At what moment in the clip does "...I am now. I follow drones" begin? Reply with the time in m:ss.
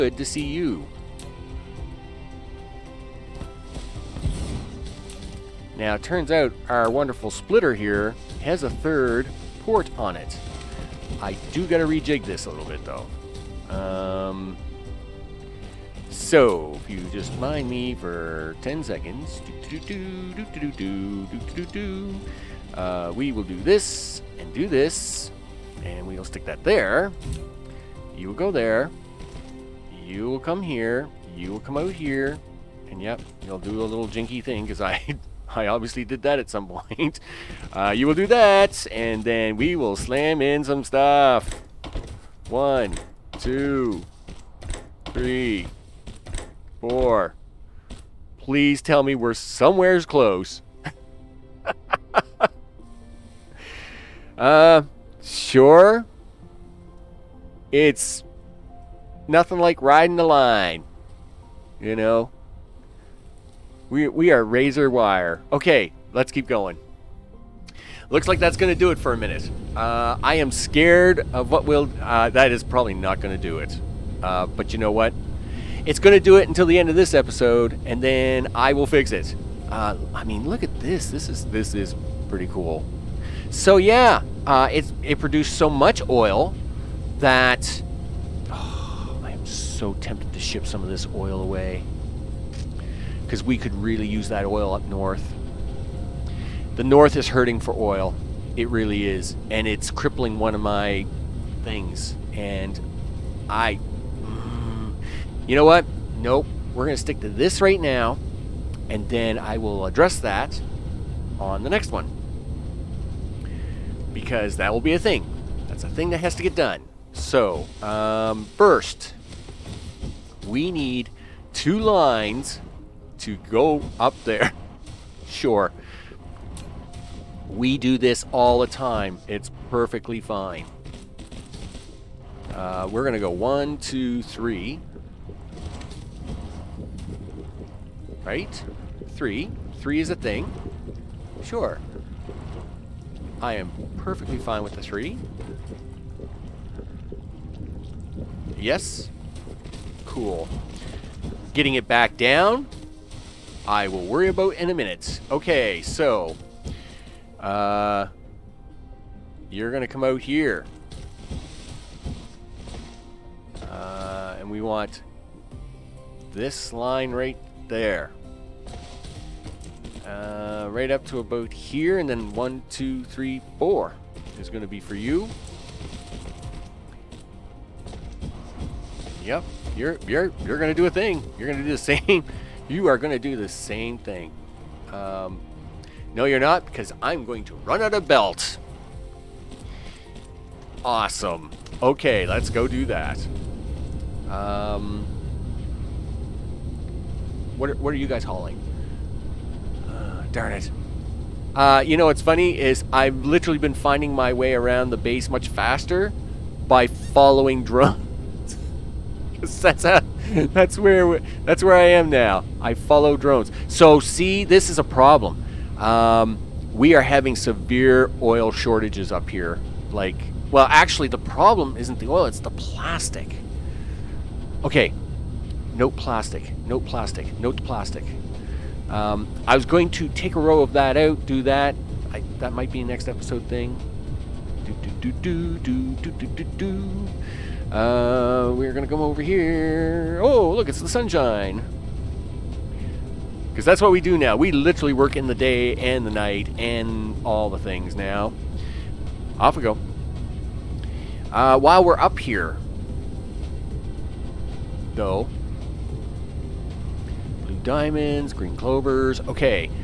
3:31.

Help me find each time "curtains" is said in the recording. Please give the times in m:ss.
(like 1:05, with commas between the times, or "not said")
not said.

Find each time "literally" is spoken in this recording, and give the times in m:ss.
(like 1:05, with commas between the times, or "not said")
3:23, 4:04.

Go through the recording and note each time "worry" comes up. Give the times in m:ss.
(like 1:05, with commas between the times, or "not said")
2:34.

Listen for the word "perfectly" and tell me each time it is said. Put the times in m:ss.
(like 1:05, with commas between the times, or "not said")
2:09, 2:23.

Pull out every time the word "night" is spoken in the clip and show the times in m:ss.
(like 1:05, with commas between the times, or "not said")
4:06.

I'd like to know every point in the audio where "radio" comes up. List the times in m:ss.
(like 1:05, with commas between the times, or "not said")
not said.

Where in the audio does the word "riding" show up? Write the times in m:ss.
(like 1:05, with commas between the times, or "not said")
0:59.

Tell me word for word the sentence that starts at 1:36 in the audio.
The north is hurting for oil.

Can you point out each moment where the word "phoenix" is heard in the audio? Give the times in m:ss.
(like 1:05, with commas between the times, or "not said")
not said.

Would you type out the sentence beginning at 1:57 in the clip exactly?
So, um, first, we need two lines to go up there.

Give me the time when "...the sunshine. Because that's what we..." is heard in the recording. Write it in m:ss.
4:00.